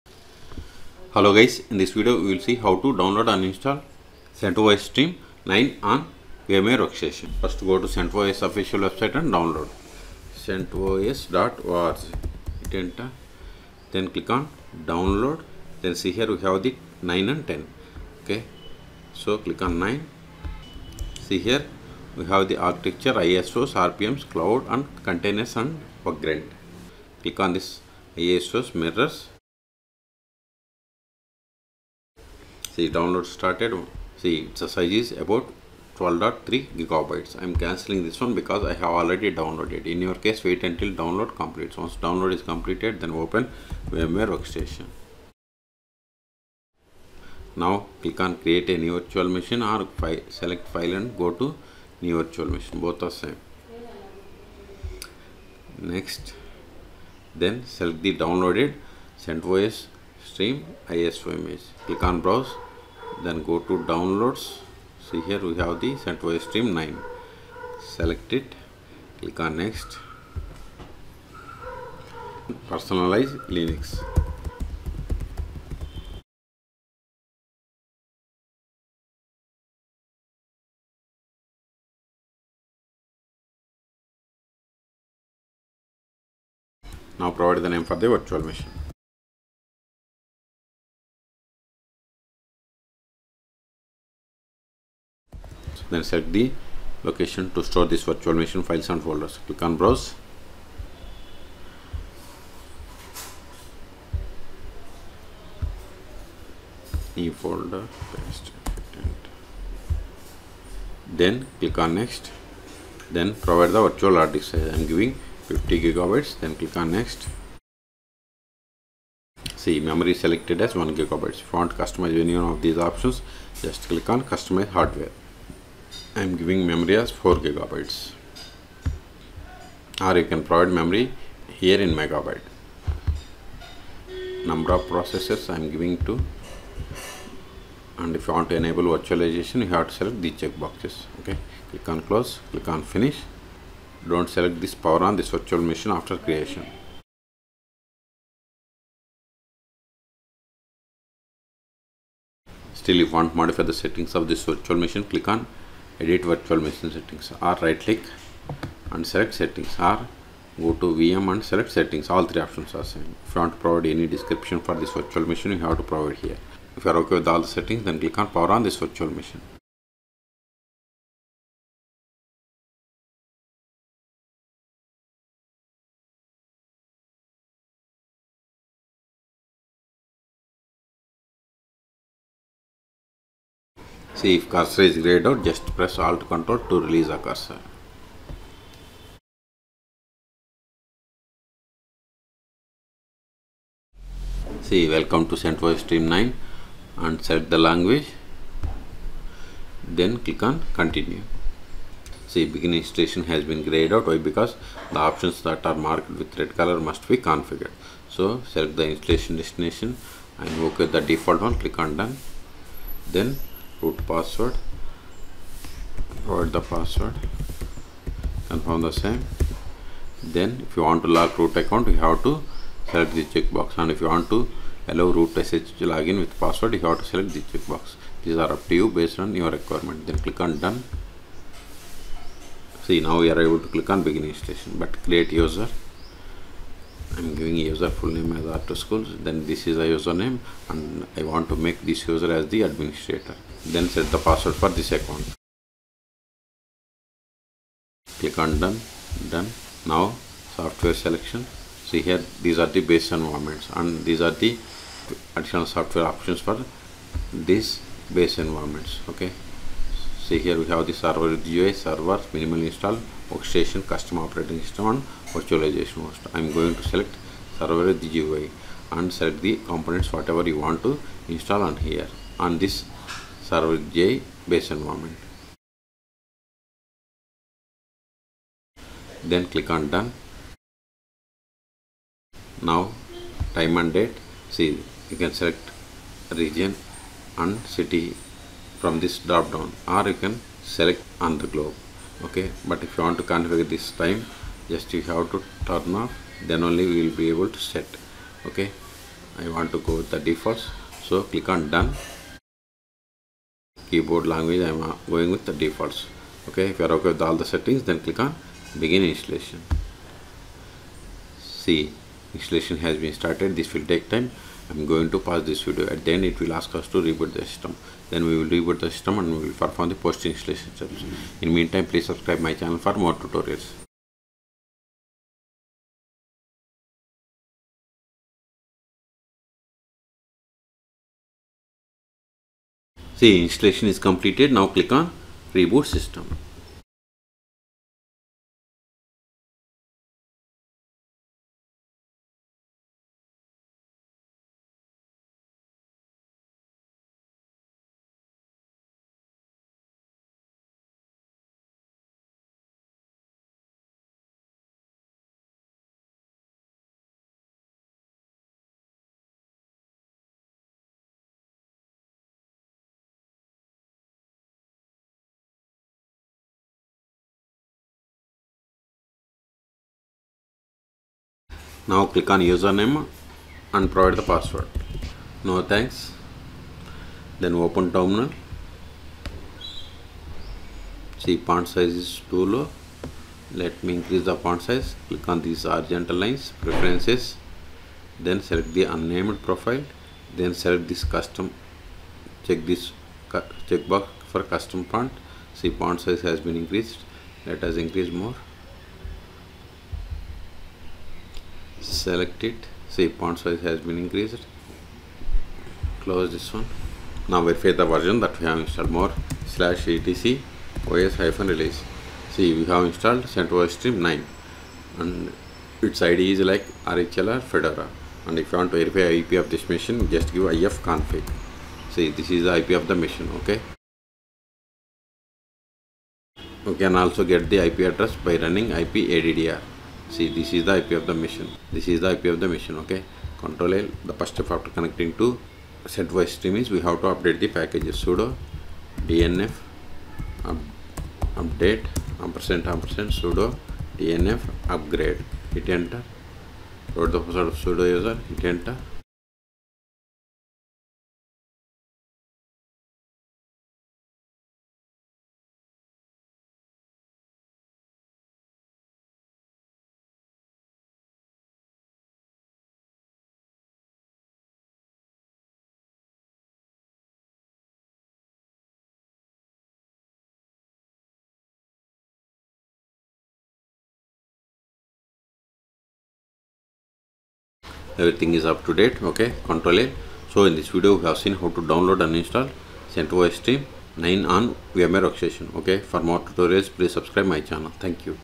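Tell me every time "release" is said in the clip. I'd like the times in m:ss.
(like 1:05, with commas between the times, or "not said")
3:06, 6:51.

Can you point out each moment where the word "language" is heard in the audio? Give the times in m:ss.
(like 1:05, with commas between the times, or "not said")
3:17, 5:04.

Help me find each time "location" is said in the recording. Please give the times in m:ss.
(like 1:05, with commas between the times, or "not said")
1:37.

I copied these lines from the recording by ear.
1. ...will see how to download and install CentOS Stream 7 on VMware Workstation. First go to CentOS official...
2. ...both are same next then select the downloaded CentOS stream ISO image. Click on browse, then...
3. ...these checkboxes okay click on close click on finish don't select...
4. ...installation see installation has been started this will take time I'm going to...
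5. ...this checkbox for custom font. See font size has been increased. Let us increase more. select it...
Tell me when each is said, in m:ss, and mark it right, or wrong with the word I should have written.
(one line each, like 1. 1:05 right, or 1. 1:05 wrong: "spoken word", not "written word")
1. 0:02 wrong: "9", not "7"
2. 0:52 right
3. 2:20 right
4. 5:09 right
5. 6:32 right.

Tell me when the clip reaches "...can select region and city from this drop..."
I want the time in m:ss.
4:45.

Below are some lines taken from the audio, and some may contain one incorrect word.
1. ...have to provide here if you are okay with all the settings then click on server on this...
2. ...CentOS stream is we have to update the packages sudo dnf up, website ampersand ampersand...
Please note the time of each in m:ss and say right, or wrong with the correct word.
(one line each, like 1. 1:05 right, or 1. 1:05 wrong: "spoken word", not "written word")
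1. 2:45 wrong: "power", not "server"
2. 7:15 wrong: "update", not "website".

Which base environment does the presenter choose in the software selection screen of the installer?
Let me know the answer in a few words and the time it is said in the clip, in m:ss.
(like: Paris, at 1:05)
Server with UI, at 4:27.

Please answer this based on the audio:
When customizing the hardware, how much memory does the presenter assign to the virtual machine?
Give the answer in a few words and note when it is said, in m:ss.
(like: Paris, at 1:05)
4 gigabytes, at 2:07.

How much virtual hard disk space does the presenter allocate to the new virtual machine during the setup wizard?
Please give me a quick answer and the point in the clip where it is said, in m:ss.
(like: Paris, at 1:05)
50 gigabytes, at 1:55.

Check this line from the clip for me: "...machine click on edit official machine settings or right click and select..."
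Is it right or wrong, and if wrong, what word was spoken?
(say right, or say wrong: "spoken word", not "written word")
wrong: "virtual", not "official".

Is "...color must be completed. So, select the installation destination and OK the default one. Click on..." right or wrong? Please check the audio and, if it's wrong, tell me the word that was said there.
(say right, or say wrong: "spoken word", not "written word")
wrong: "configured", not "completed".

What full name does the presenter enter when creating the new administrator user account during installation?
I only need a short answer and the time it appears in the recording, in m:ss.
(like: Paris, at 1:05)
R2 Schools, at 3:58.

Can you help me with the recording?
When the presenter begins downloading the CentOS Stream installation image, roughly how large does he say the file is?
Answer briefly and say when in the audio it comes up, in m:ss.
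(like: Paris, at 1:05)
12.3 gigabytes, at 0:35.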